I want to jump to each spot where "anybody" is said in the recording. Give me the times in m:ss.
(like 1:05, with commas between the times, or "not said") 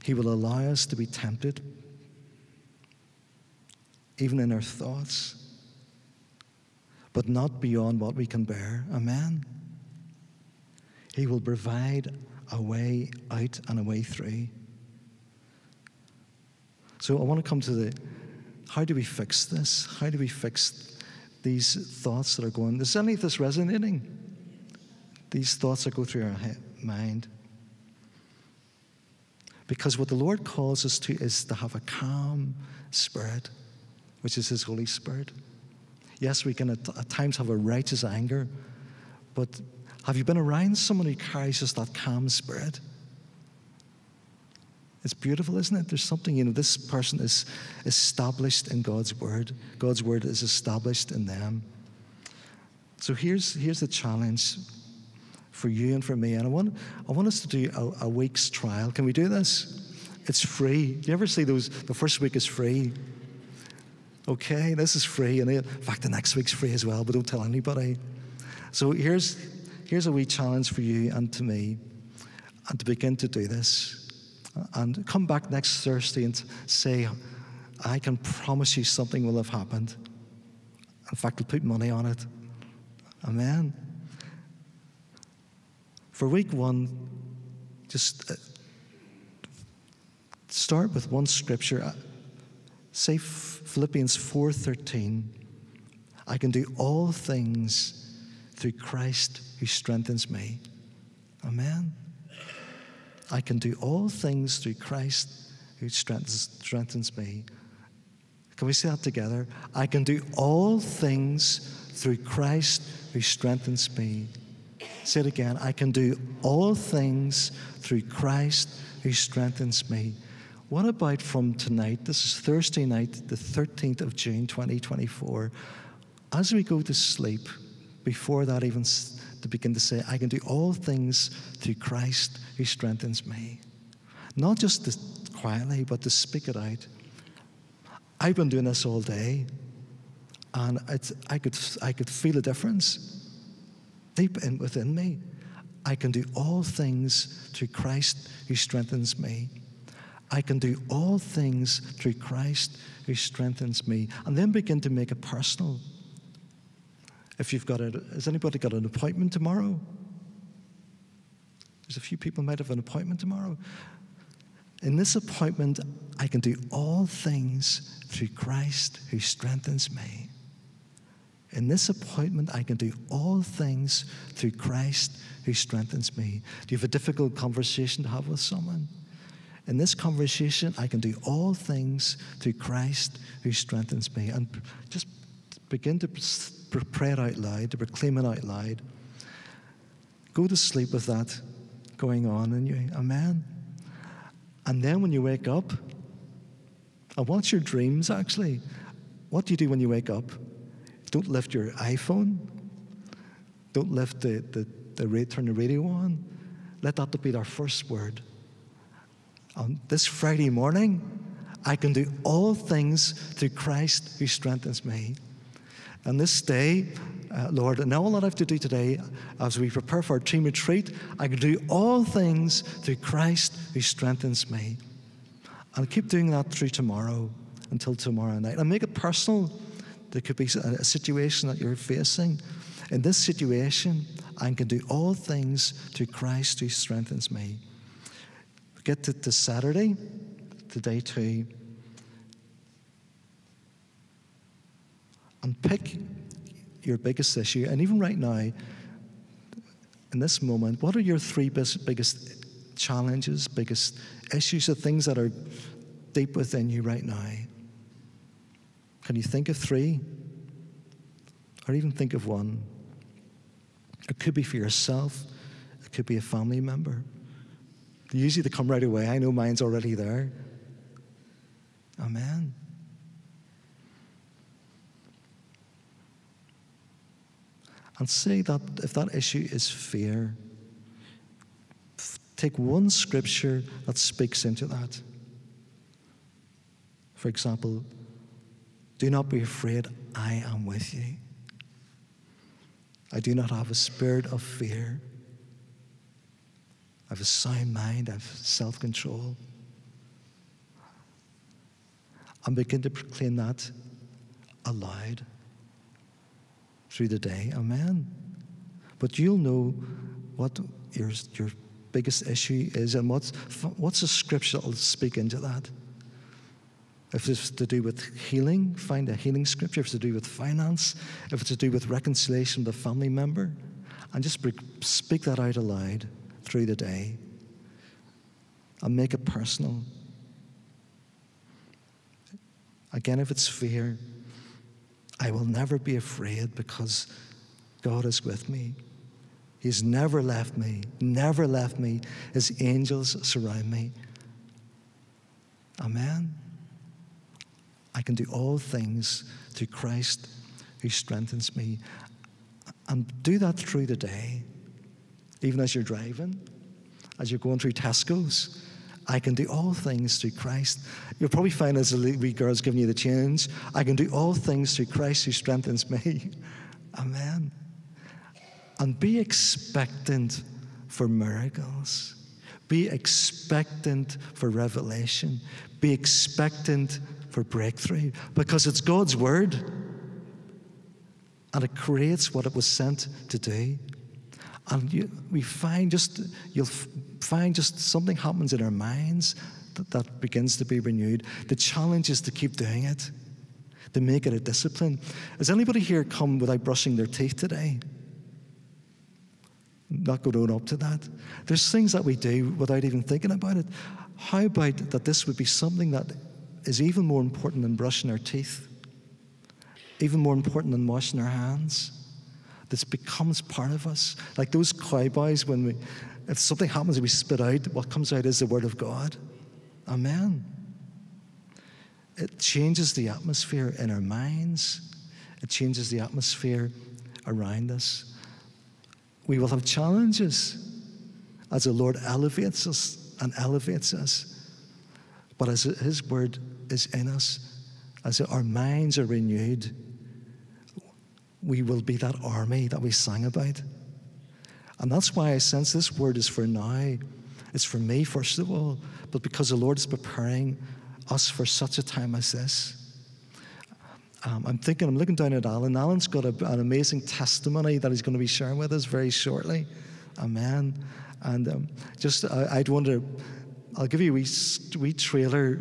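1:07, 2:38, 6:35.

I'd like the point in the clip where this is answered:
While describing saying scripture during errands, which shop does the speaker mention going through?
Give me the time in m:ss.
5:57.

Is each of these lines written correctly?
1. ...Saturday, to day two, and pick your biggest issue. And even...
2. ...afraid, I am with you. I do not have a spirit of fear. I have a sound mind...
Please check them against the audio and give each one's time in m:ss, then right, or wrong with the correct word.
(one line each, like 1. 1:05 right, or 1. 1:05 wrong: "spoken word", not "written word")
1. 3:59 right
2. 4:49 right.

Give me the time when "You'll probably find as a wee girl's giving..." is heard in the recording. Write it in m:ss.
6:01.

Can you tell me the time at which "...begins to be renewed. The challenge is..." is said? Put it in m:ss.
6:30.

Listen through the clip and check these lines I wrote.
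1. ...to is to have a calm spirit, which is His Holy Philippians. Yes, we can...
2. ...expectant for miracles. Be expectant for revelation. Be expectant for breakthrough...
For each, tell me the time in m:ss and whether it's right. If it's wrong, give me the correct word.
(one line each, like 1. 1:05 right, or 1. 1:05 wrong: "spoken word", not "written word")
1. 0:30 wrong: "Spirit", not "Philippians"
2. 6:09 right.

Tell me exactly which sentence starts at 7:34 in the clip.
Um, I'm thinking, I'm looking down at Alan.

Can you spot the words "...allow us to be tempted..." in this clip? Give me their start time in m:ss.
0:00.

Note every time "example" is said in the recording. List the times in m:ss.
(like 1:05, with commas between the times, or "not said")
4:47.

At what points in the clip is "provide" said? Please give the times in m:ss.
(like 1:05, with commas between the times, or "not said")
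0:11.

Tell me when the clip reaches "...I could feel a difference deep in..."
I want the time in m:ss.
2:21.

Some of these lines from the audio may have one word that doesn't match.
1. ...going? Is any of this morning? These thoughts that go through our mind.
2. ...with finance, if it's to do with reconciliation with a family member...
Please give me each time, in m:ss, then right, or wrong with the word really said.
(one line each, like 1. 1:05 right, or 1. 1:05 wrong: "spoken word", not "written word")
1. 0:22 wrong: "resonating", not "morning"
2. 5:20 right.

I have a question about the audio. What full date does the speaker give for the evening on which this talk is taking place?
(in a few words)
13th of June, 2024.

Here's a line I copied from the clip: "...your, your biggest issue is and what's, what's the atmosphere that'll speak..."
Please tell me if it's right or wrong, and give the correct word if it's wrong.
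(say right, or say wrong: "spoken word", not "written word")
wrong: "scripture", not "atmosphere".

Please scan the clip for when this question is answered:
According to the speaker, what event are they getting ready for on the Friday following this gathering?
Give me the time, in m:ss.
3:40.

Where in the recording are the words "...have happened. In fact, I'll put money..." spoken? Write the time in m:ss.
1:19.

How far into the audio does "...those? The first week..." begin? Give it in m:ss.
1:01.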